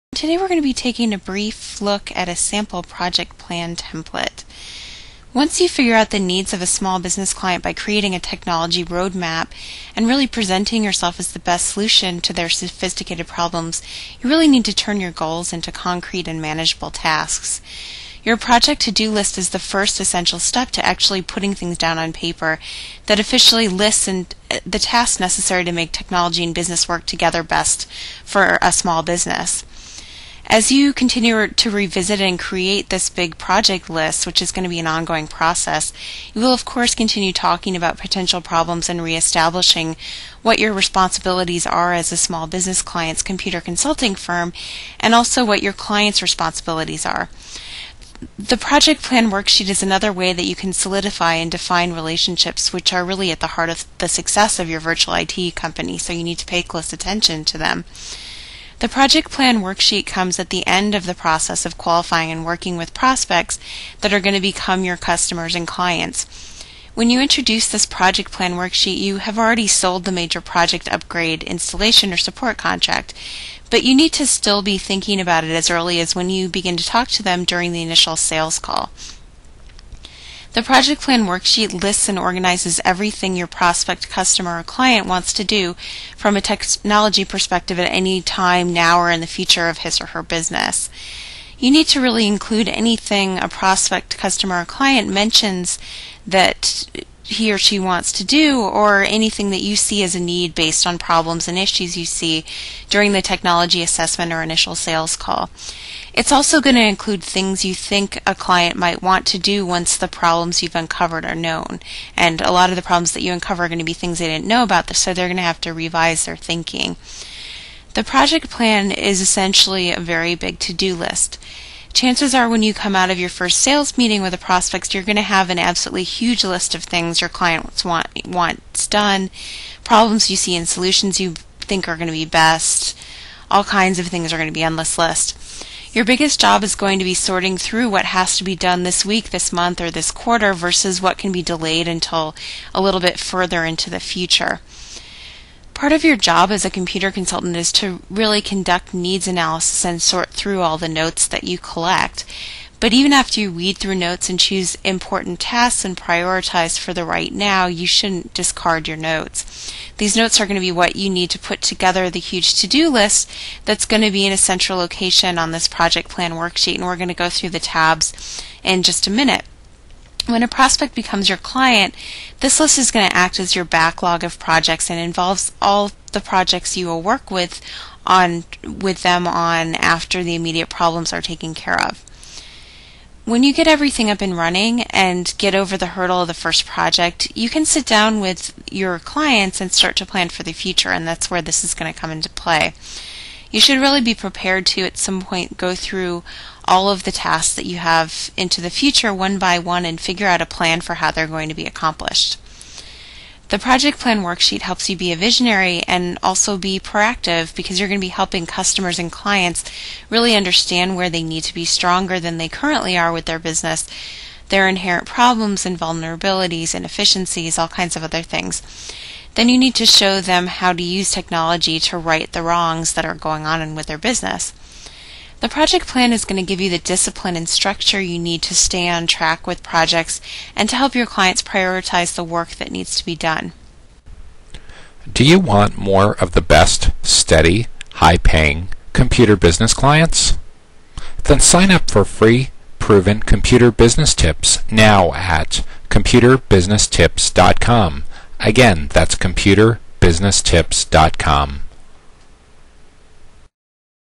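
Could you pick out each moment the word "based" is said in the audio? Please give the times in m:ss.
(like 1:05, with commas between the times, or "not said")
1:40.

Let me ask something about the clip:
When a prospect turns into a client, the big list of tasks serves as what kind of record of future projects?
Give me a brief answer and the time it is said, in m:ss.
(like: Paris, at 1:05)
Backlog, at 2:53.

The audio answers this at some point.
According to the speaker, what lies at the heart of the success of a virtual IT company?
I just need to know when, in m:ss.
0:51.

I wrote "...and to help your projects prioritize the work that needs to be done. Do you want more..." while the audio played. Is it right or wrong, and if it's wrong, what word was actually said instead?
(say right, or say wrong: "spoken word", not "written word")
wrong: "clients", not "projects".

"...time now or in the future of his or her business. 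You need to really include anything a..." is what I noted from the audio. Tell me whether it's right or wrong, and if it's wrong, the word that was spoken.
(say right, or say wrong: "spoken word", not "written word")
right.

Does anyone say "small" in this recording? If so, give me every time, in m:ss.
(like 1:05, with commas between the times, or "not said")
0:06, 0:28, 0:42.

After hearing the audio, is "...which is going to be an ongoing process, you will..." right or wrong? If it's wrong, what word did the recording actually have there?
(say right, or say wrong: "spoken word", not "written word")
right.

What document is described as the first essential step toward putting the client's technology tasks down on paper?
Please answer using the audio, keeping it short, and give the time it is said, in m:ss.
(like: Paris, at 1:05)
Project to-do list, at 0:18.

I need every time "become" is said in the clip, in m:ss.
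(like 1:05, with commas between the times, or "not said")
1:04, 2:50.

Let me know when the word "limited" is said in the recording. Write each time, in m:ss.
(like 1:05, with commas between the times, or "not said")
not said.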